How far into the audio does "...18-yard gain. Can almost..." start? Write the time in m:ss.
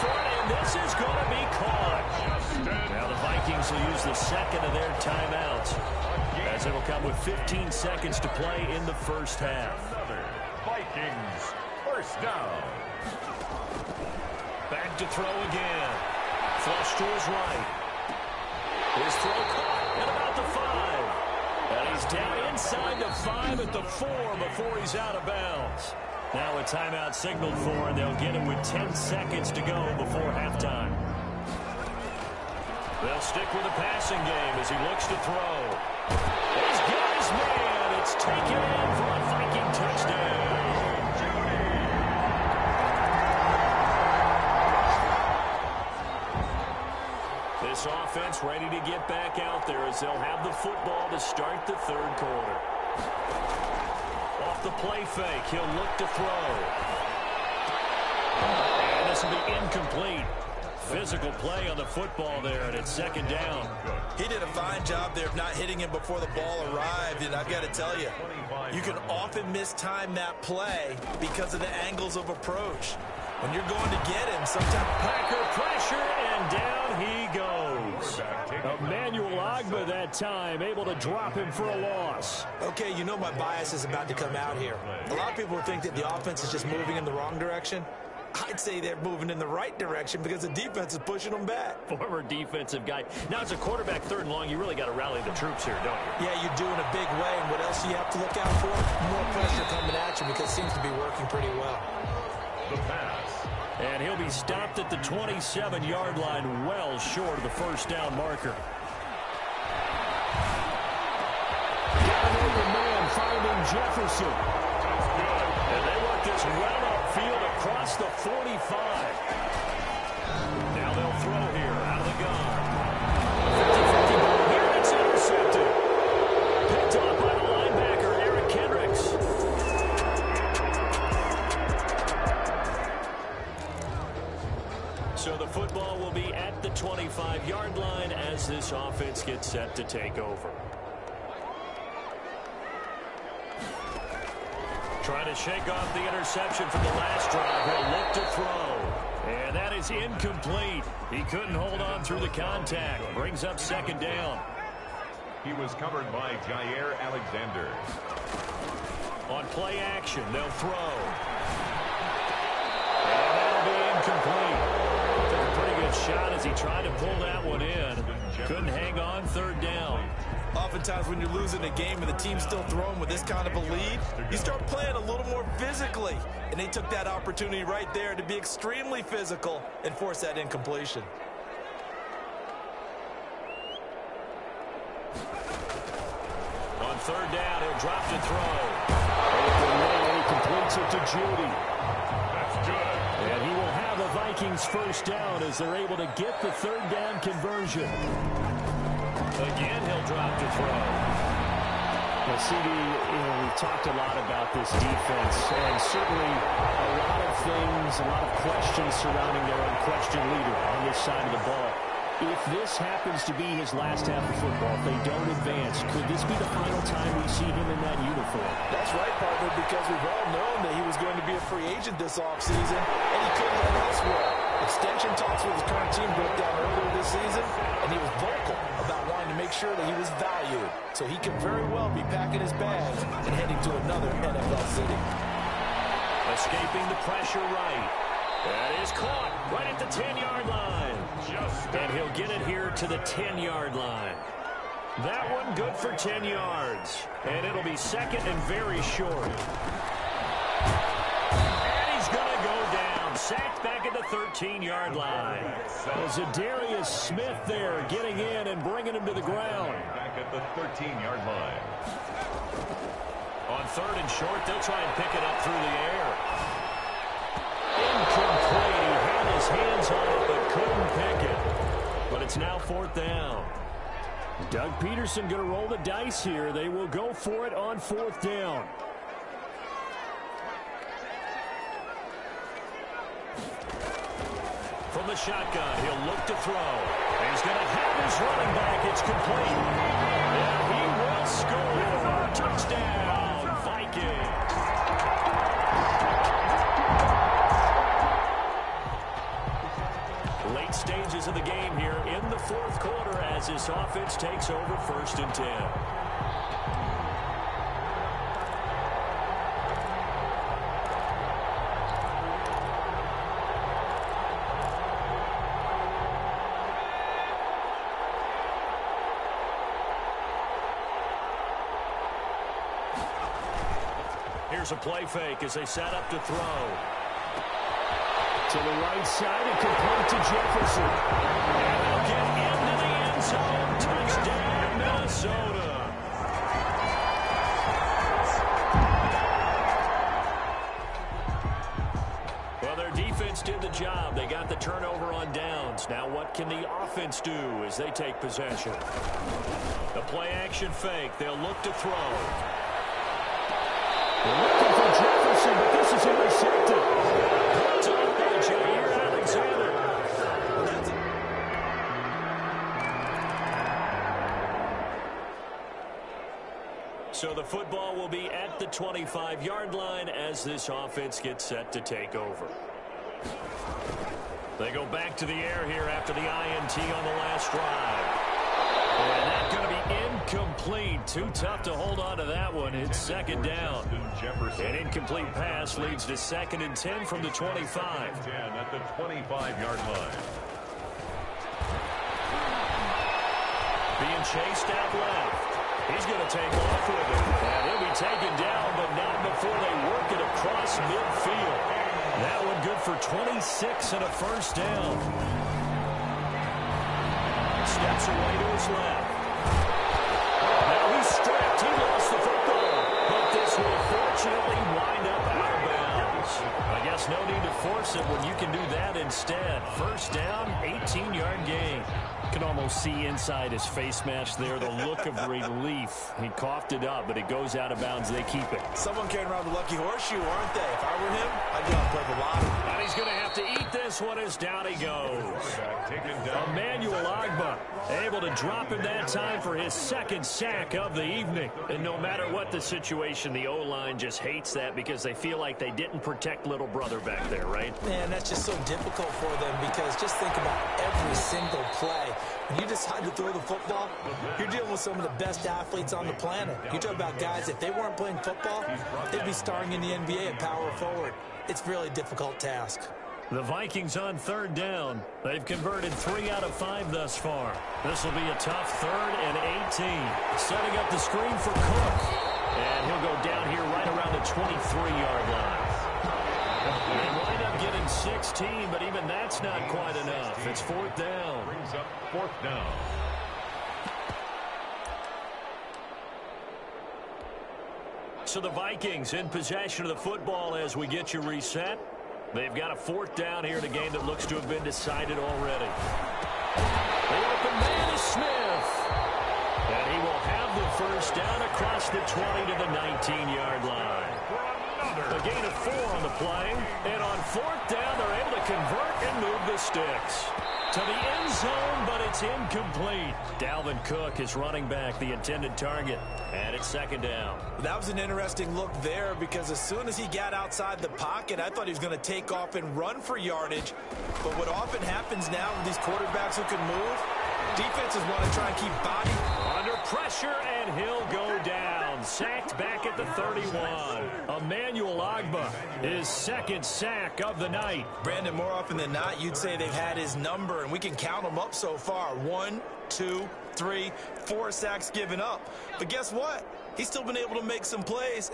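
7:00.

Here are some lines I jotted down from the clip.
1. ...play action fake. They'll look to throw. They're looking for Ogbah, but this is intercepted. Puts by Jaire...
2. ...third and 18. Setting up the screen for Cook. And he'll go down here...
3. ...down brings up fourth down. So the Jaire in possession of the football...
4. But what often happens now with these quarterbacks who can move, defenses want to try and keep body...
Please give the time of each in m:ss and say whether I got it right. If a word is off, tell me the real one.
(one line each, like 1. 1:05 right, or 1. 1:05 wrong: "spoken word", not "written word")
1. 5:50 wrong: "Jefferson", not "Ogbah"
2. 7:48 right
3. 8:00 wrong: "Vikings", not "Jaire"
4. 8:44 right.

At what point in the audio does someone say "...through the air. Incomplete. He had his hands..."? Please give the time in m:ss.
4:25.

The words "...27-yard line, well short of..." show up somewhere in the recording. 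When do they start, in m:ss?
1:44.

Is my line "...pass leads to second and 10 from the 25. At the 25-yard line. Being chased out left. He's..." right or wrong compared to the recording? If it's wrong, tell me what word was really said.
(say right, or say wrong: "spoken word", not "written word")
right.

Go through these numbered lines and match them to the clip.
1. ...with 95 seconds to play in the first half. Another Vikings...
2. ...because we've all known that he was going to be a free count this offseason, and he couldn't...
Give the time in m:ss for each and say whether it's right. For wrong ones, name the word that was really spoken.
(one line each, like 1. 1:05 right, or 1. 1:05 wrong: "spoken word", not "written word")
1. 0:07 wrong: "15", not "95"
2. 3:39 wrong: "agent", not "count".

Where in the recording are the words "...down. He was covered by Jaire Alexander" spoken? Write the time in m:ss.
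2:33.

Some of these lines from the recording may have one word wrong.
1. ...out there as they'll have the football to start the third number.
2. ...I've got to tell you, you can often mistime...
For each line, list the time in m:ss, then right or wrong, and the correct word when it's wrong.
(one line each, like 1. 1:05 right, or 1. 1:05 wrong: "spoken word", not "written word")
1. 0:49 wrong: "quarter", not "number"
2. 1:07 right.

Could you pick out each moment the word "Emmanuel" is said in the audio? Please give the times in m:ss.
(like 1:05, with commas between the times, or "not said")
1:18, 7:16, 8:54.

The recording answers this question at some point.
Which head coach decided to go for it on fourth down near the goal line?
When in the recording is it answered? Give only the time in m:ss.
4:34.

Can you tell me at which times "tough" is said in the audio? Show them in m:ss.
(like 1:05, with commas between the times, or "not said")
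6:21, 7:48.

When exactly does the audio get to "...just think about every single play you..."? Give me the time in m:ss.
7:30.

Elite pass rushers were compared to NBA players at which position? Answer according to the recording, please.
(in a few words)
Power forward.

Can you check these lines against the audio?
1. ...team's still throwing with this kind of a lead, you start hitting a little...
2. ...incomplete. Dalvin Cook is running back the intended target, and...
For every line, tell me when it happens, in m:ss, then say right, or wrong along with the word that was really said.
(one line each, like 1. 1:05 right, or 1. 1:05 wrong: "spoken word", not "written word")
1. 2:52 wrong: "playing", not "hitting"
2. 8:32 right.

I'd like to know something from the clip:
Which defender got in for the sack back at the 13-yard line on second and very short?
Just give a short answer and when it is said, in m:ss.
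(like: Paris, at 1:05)
Adarius Smith, at 4:16.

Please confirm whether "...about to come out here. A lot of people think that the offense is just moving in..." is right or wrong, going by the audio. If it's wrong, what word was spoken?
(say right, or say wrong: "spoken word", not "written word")
right.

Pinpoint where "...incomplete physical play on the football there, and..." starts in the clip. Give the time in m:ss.
0:59.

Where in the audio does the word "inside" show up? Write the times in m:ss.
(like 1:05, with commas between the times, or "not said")
0:22, 7:03.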